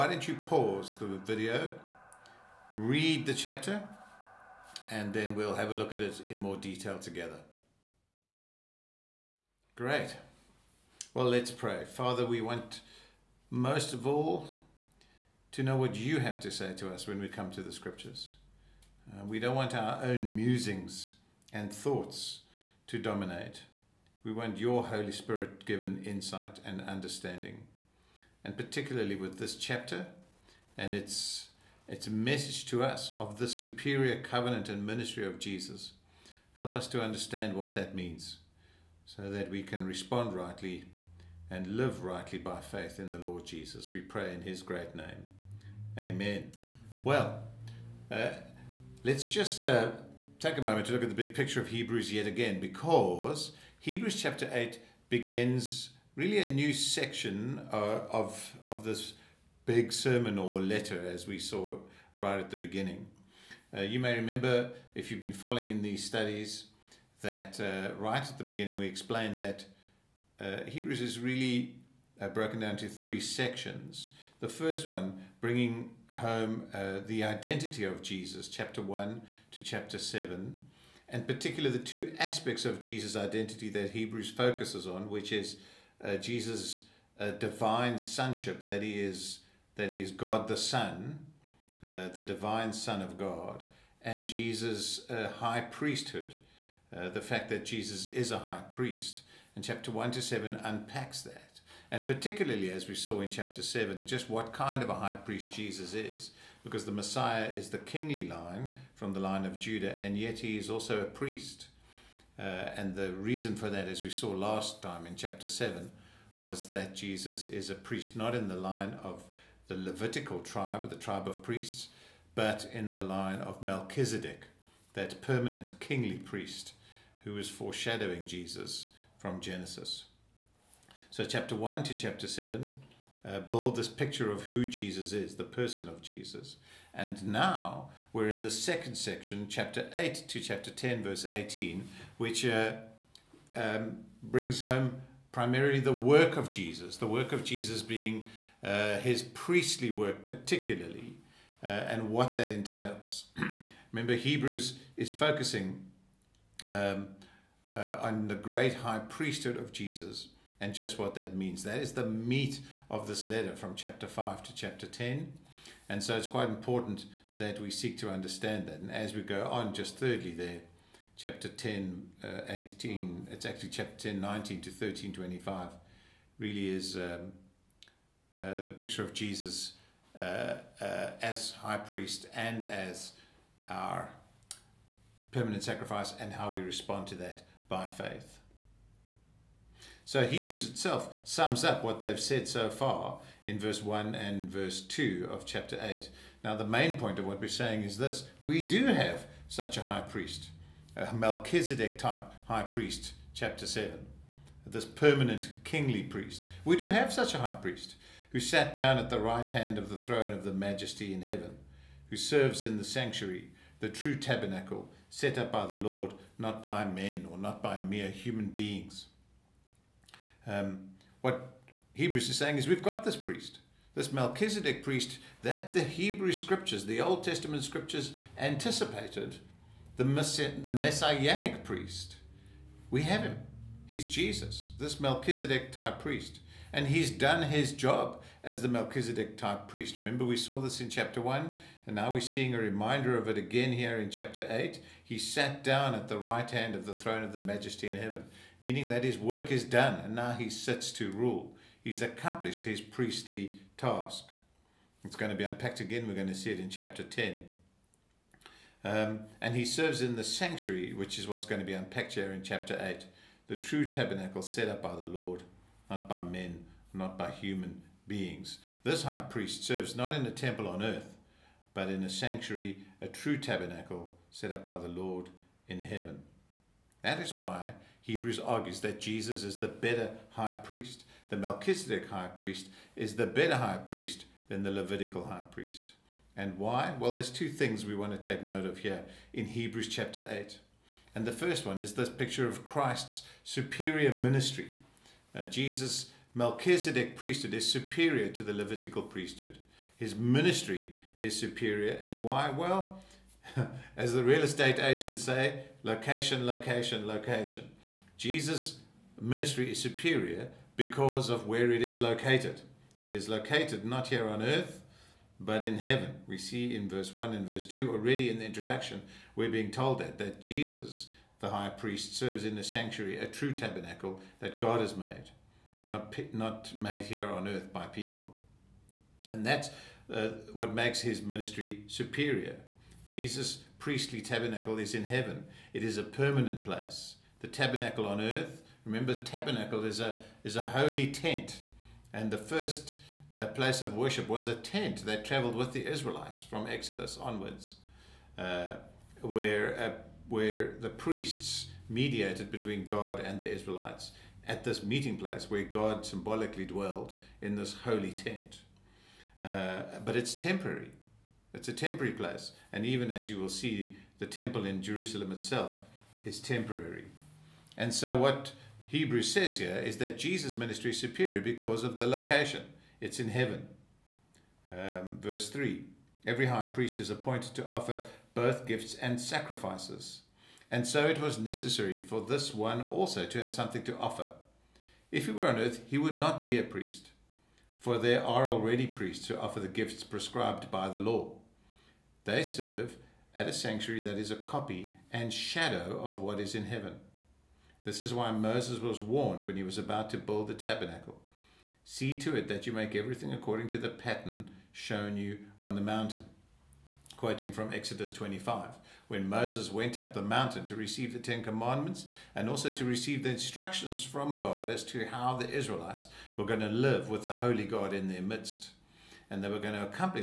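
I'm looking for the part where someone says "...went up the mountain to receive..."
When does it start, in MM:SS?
06:49.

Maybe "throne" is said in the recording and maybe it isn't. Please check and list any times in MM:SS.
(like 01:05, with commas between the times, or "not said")
03:30, 04:06.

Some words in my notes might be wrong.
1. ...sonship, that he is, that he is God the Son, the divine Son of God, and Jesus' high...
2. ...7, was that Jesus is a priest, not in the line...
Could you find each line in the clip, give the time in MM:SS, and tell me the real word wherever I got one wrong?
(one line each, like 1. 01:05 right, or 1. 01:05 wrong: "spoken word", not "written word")
1. 01:27 right
2. 01:55 right.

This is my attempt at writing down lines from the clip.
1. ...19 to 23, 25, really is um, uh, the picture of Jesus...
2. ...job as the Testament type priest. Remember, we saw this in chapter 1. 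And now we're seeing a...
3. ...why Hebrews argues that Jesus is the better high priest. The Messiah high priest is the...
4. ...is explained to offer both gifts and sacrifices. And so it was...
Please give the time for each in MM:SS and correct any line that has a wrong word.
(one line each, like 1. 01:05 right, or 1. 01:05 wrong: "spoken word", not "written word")
1. 02:54 wrong: "13", not "23"
2. 03:57 wrong: "Melchizedek", not "Testament"
3. 04:37 wrong: "Melchizedek", not "Messiah"
4. 06:16 wrong: "appointed", not "explained".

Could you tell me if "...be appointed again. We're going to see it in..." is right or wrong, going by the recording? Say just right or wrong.
wrong.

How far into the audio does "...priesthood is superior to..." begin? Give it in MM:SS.
04:57.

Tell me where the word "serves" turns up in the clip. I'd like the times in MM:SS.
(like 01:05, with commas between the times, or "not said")
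03:32, 04:19, 04:29, 05:22, 06:32.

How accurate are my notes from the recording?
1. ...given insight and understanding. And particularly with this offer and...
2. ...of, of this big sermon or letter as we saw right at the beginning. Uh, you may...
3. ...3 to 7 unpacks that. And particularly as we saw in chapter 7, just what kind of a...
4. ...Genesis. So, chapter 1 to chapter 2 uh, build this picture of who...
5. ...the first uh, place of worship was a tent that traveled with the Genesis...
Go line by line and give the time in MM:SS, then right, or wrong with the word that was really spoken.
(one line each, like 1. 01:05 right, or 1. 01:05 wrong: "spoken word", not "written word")
1. 00:25 wrong: "chapter", not "offer"
2. 00:58 right
3. 01:39 wrong: "1", not "3"
4. 02:09 wrong: "7", not "2"
5. 05:42 wrong: "Israelites", not "Genesis".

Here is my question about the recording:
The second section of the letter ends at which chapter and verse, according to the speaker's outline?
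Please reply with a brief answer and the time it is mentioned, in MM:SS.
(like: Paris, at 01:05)
Chapter 10, verse 18, at 02:20.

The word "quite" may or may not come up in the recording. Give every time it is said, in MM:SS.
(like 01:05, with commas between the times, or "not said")
02:46.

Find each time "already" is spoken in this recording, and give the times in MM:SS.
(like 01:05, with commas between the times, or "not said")
05:17, 06:28.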